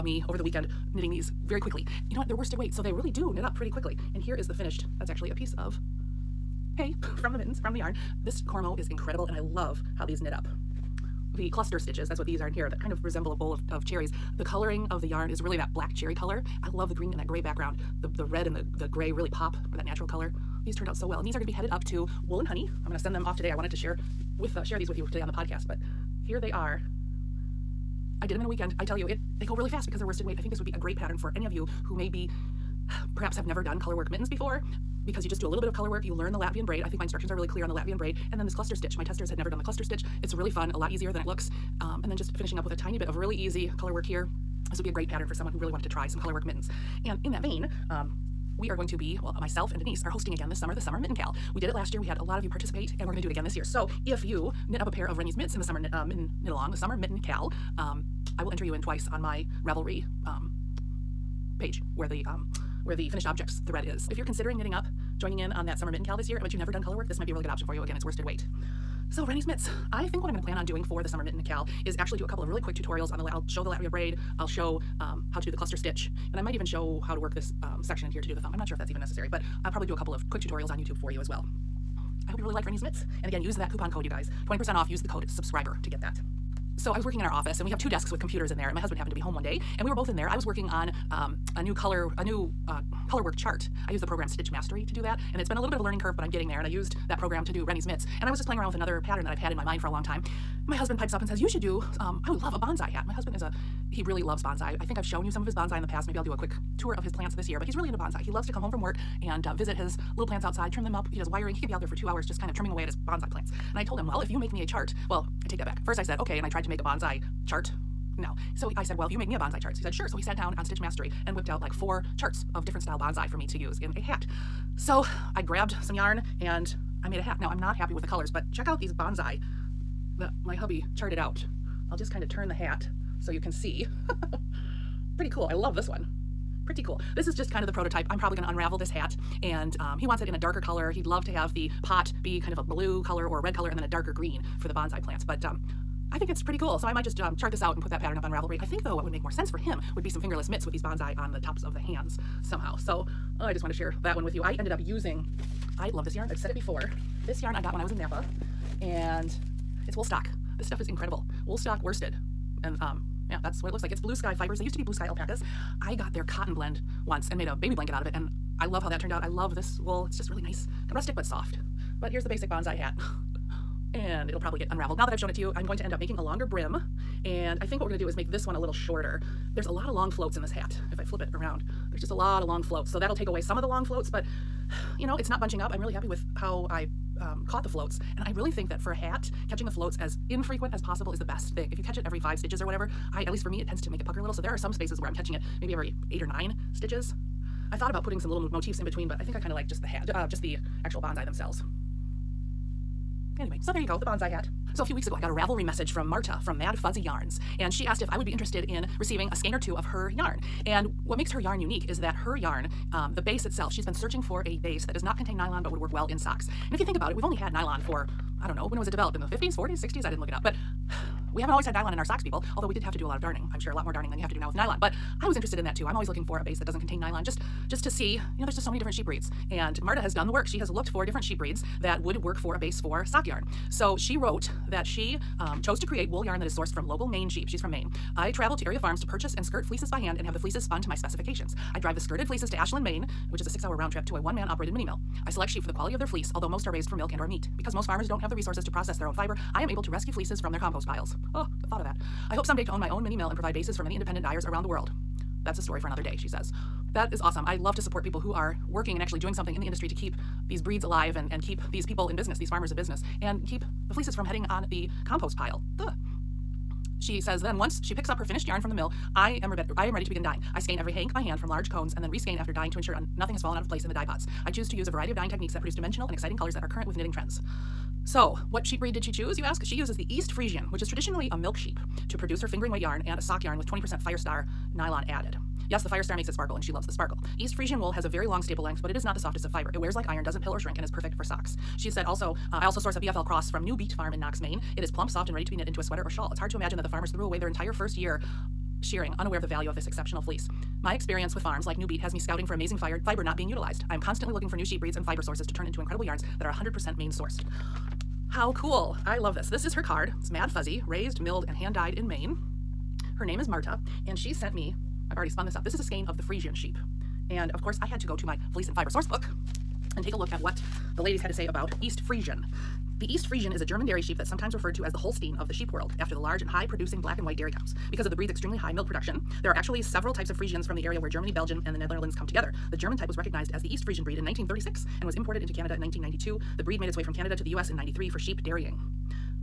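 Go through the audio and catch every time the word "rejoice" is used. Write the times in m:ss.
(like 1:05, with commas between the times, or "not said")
not said.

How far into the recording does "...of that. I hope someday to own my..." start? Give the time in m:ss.
4:11.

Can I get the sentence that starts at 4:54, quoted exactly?
It is plump, soft, and ready to be knit into a sweater or shawl.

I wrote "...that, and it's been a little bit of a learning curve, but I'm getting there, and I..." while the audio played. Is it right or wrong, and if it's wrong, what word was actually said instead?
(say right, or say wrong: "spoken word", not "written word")
right.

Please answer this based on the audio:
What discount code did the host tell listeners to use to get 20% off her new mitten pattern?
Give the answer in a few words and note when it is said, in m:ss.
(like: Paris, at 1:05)
SUBSCRIBER, at 1:24.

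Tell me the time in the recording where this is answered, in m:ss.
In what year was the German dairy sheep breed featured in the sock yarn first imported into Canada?
5:35.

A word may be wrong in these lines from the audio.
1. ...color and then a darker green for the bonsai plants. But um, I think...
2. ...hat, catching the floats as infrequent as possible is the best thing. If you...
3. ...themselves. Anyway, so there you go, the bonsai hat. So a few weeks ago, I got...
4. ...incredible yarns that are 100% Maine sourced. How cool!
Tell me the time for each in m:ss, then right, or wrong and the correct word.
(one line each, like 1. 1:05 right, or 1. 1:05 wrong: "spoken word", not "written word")
1. 2:23 right
2. 3:08 right
3. 3:21 right
4. 5:05 right.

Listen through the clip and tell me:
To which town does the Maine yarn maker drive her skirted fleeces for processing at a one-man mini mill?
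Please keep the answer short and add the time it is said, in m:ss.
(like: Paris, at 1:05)
Ashland, Maine, at 4:02.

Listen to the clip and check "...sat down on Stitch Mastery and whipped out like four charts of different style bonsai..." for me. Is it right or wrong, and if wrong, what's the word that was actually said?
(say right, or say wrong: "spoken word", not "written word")
right.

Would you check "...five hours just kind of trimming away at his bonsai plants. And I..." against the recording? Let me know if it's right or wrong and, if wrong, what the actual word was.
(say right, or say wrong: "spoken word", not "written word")
wrong: "two", not "five".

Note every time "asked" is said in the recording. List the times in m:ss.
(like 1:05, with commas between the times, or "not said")
3:27.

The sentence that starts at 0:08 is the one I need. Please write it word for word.
This Cormo is incredible and I love how these knit up.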